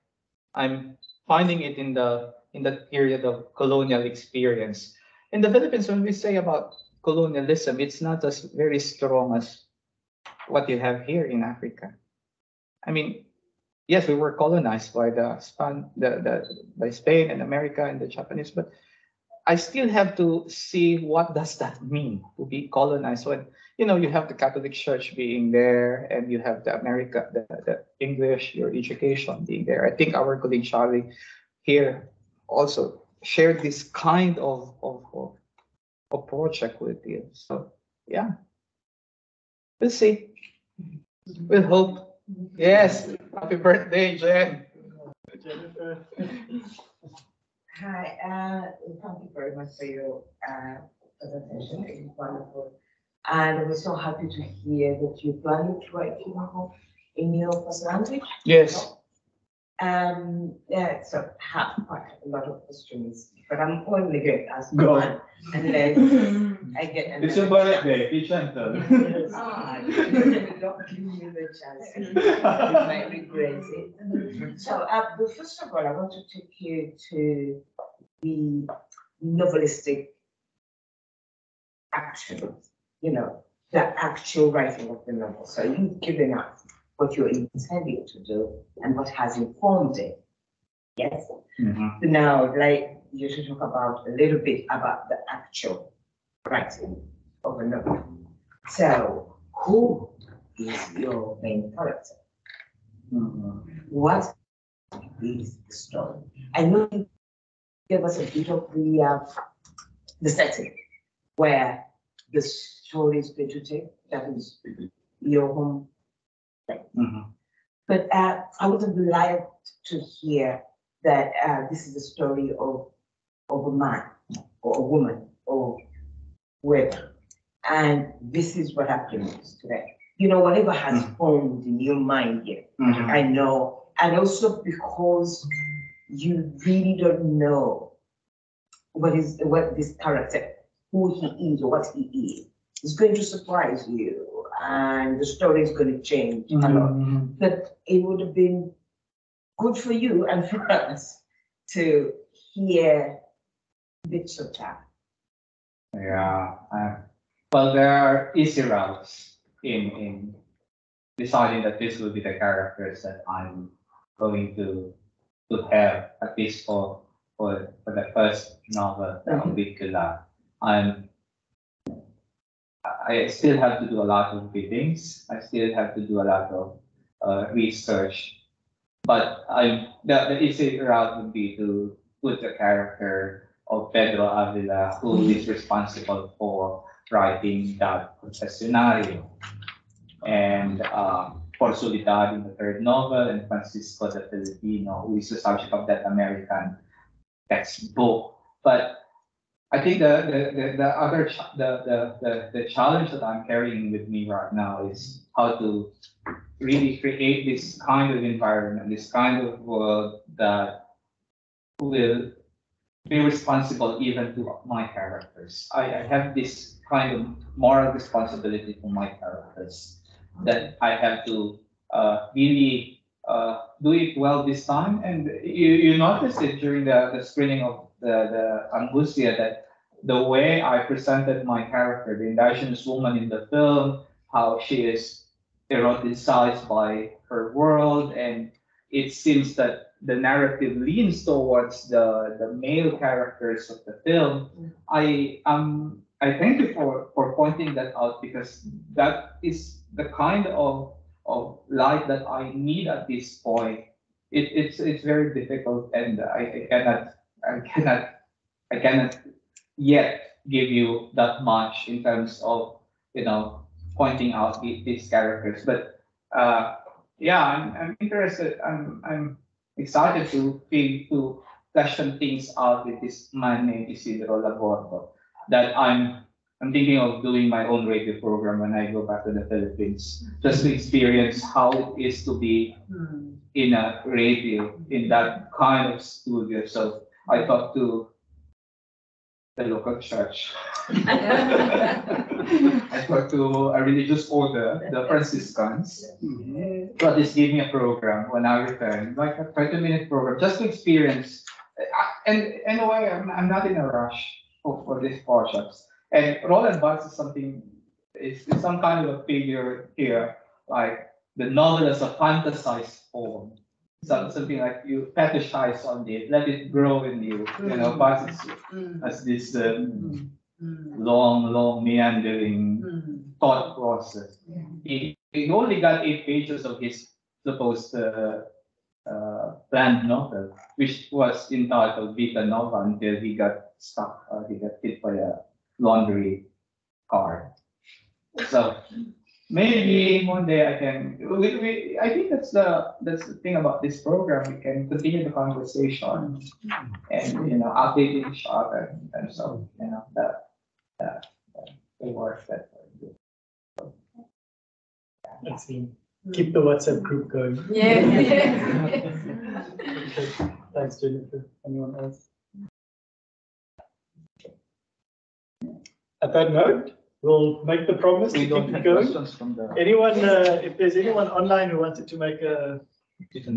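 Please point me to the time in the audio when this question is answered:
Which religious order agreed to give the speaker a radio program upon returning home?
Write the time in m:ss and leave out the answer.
4:54.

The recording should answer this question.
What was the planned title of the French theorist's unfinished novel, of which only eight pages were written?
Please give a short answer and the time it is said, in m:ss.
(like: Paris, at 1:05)
Vita Nova, at 5:32.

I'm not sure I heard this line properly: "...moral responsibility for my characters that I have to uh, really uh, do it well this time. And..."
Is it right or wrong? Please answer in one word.
right.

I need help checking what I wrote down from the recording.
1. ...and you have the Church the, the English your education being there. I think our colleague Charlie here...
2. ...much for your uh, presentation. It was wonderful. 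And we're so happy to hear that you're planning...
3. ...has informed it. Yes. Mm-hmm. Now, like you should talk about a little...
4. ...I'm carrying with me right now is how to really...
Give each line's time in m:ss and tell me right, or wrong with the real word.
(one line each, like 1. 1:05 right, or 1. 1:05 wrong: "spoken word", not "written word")
1. 0:26 wrong: "America", not "Church"
2. 0:49 right
3. 1:29 right
4. 3:23 right.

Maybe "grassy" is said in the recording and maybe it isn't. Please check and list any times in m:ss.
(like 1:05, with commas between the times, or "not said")
not said.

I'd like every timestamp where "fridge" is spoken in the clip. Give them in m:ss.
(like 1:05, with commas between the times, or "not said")
not said.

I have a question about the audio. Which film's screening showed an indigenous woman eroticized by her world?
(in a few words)
Angustia.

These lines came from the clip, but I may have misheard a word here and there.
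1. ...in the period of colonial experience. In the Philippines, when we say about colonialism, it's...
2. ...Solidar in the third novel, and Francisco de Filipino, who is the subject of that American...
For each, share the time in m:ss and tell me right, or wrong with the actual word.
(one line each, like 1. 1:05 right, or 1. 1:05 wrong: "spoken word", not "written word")
1. 0:02 right
2. 3:11 right.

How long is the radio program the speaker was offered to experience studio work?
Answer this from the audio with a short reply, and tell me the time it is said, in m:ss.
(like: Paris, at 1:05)
20 minutes, at 4:59.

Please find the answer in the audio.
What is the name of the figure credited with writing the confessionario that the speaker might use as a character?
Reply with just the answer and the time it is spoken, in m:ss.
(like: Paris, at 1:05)
Pedro Avila, at 3:03.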